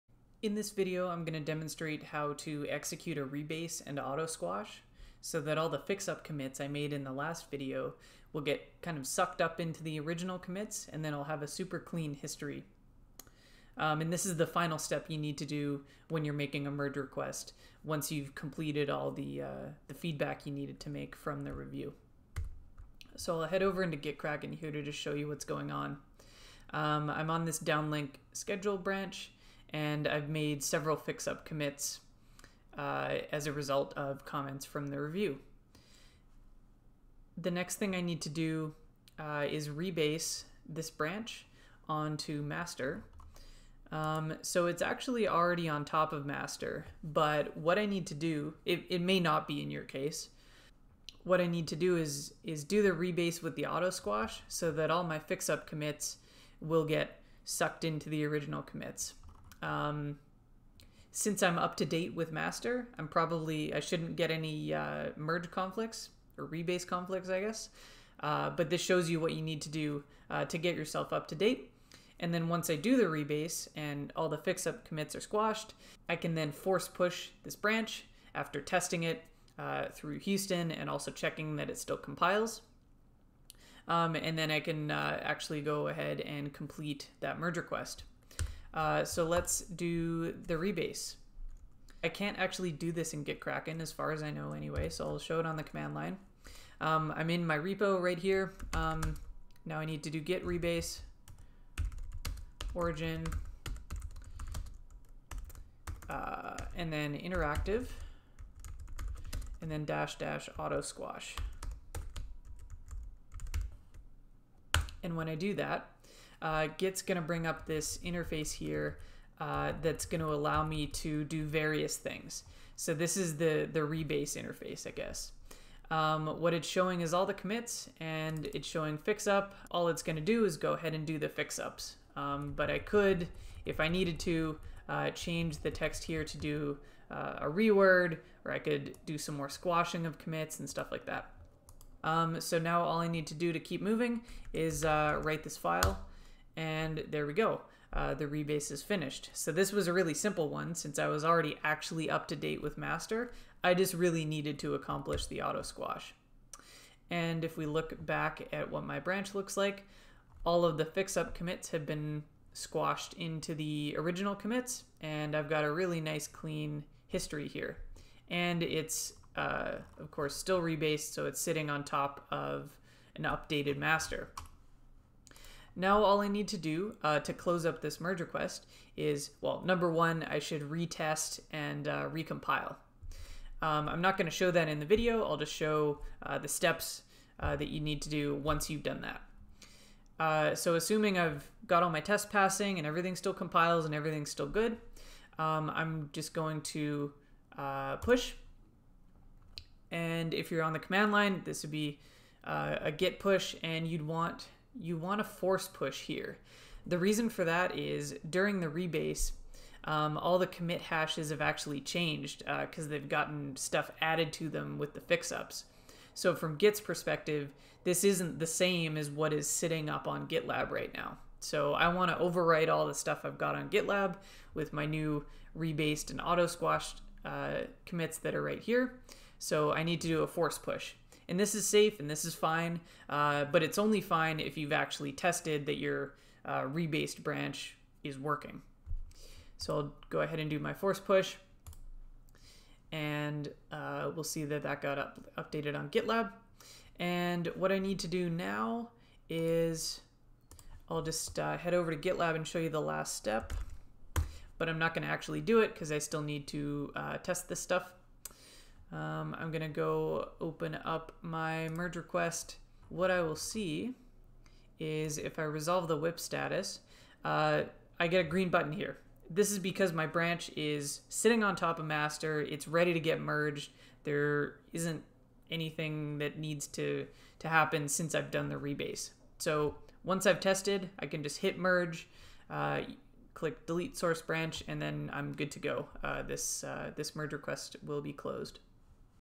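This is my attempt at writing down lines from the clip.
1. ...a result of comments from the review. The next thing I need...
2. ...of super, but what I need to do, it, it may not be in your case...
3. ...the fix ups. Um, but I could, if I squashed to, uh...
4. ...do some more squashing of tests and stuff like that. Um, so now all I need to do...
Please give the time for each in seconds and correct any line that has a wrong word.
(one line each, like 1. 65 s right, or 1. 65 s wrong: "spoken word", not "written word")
1. 33 s right
2. 46 s wrong: "master", not "super"
3. 131 s wrong: "needed", not "squashed"
4. 139 s wrong: "commits", not "tests".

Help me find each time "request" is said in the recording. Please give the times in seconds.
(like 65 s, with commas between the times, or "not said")
16 s, 87 s, 178 s, 261 s, 287 s.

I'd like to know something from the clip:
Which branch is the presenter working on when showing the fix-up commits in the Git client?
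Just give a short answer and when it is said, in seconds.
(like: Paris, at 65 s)
downlink schedule, at 27 s.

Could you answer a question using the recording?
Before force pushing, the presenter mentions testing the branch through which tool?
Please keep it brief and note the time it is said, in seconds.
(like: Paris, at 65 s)
Houston, at 80 s.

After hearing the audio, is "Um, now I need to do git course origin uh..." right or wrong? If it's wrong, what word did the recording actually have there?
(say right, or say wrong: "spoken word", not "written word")
wrong: "rebase", not "course".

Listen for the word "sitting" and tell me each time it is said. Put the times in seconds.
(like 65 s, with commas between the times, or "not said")
171 s, 219 s, 271 s.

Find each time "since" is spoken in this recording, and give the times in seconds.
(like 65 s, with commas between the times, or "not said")
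61 s, 150 s, 277 s.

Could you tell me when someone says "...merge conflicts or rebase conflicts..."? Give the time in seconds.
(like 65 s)
65 s.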